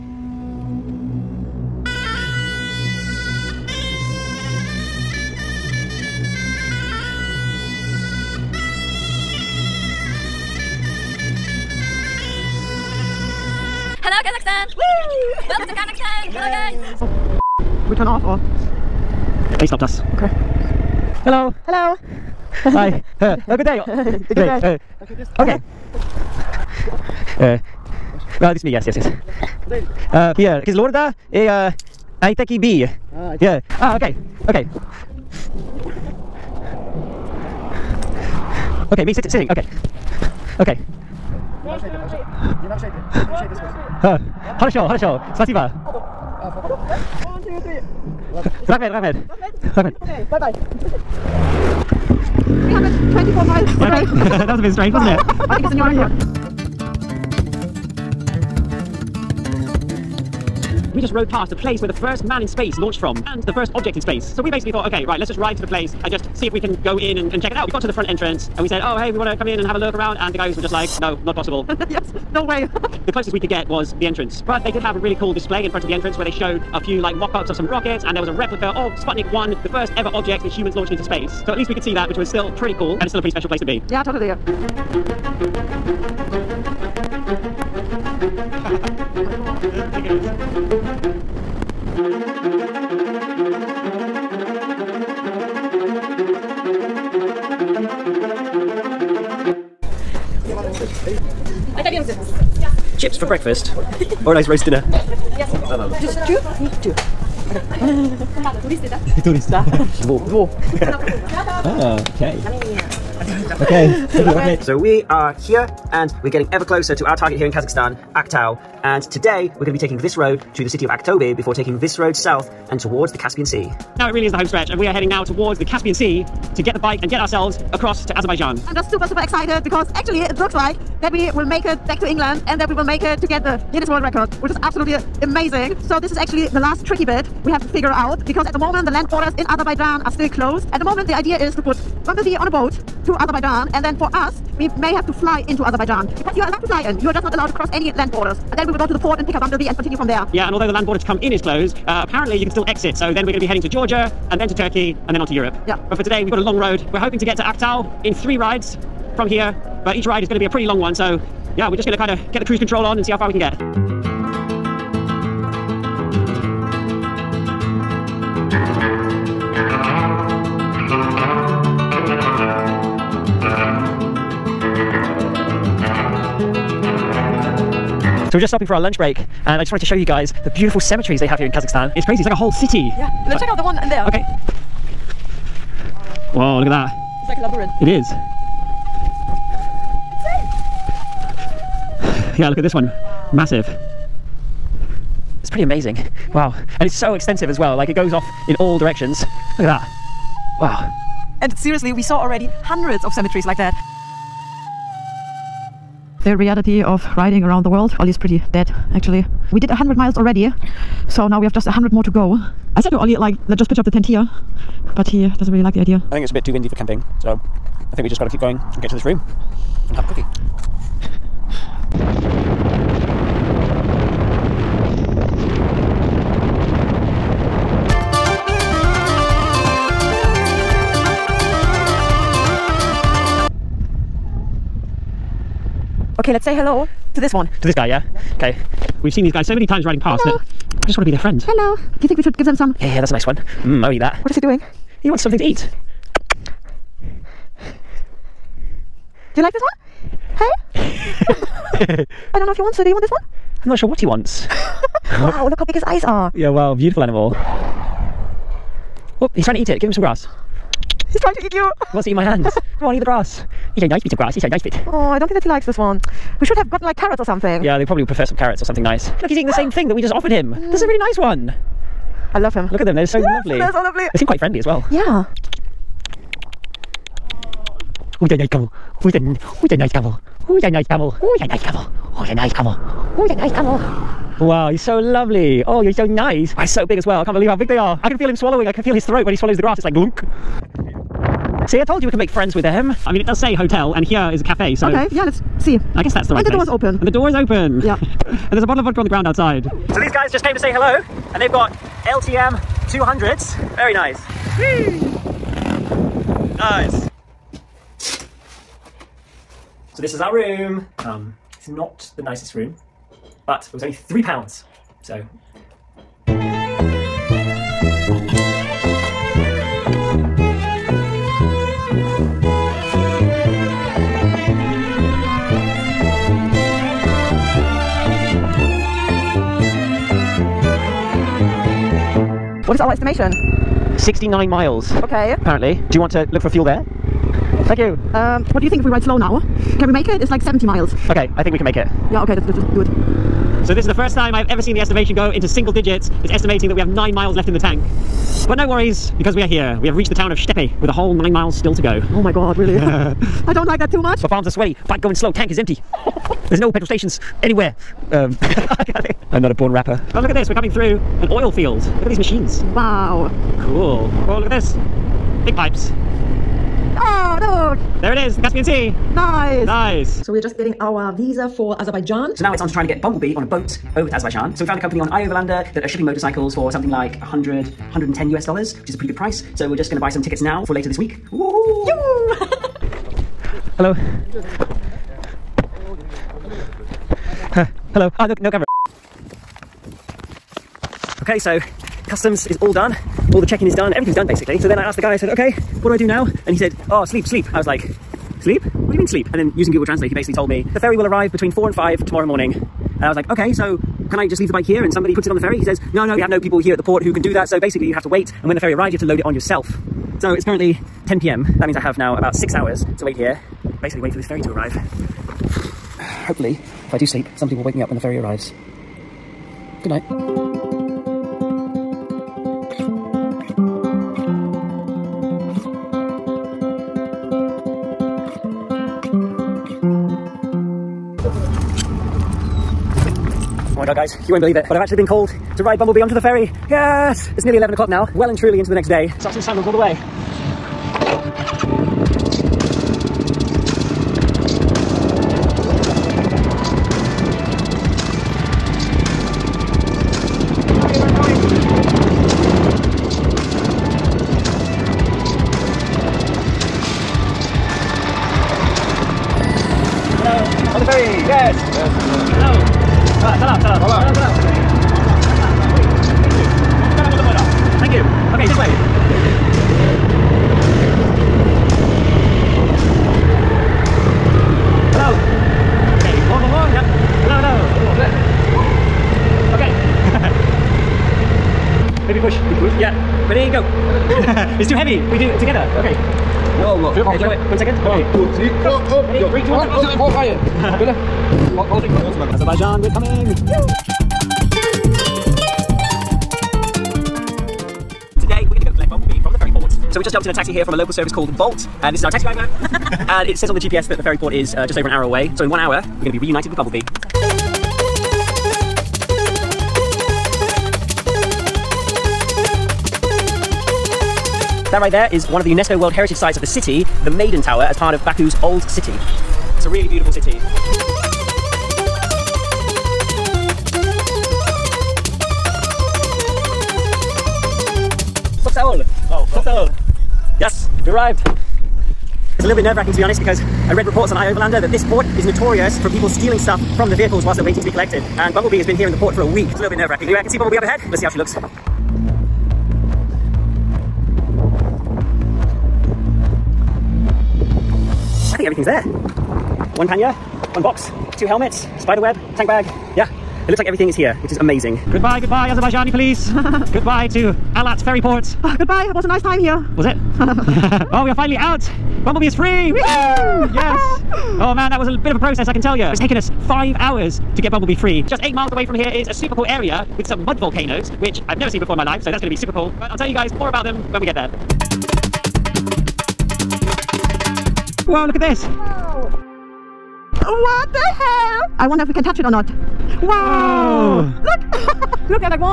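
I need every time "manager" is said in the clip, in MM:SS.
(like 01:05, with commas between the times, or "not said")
not said.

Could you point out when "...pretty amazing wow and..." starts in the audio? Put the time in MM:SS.
03:15.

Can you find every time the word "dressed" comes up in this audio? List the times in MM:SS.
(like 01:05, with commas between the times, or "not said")
not said.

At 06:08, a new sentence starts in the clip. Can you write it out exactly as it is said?
There it is, the Caspian Sea.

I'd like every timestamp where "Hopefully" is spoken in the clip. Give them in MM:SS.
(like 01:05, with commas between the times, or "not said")
06:56.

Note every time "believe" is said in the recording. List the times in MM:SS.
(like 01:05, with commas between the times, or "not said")
04:47, 07:14.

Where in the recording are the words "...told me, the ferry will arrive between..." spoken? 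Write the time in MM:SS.
06:40.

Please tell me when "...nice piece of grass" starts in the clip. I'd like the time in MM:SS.
04:23.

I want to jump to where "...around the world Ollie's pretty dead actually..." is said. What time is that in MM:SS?
03:27.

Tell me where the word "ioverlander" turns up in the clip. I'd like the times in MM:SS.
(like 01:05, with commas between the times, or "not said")
06:15, 08:54.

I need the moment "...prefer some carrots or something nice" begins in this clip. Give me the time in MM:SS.
04:28.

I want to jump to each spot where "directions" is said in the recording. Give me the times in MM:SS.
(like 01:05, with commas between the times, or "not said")
03:18.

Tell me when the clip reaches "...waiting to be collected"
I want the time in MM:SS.
08:57.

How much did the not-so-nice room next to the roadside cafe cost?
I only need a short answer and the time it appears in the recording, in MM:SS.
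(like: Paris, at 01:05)
3 pounds, at 05:13.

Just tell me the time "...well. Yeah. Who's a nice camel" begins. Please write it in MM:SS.
04:34.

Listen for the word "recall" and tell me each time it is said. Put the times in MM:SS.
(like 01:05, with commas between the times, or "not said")
not said.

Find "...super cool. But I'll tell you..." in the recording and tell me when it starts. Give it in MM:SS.
09:32.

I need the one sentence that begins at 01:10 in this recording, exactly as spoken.
And the guys were just like, no, not possible.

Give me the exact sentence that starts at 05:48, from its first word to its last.
But no worries, because we are here.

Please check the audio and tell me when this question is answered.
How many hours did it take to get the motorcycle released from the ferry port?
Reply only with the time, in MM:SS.
09:26.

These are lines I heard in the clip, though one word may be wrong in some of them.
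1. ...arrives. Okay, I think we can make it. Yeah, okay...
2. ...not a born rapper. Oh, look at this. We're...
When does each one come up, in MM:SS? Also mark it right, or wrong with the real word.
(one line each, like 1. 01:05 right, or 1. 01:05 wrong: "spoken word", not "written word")
1. 05:40 wrong: "miles", not "arrives"
2. 05:59 right.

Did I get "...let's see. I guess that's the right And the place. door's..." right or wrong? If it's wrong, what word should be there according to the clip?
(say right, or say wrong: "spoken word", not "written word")
right.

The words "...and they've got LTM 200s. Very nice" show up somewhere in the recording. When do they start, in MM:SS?
05:01.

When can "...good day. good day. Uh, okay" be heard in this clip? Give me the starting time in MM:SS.
00:23.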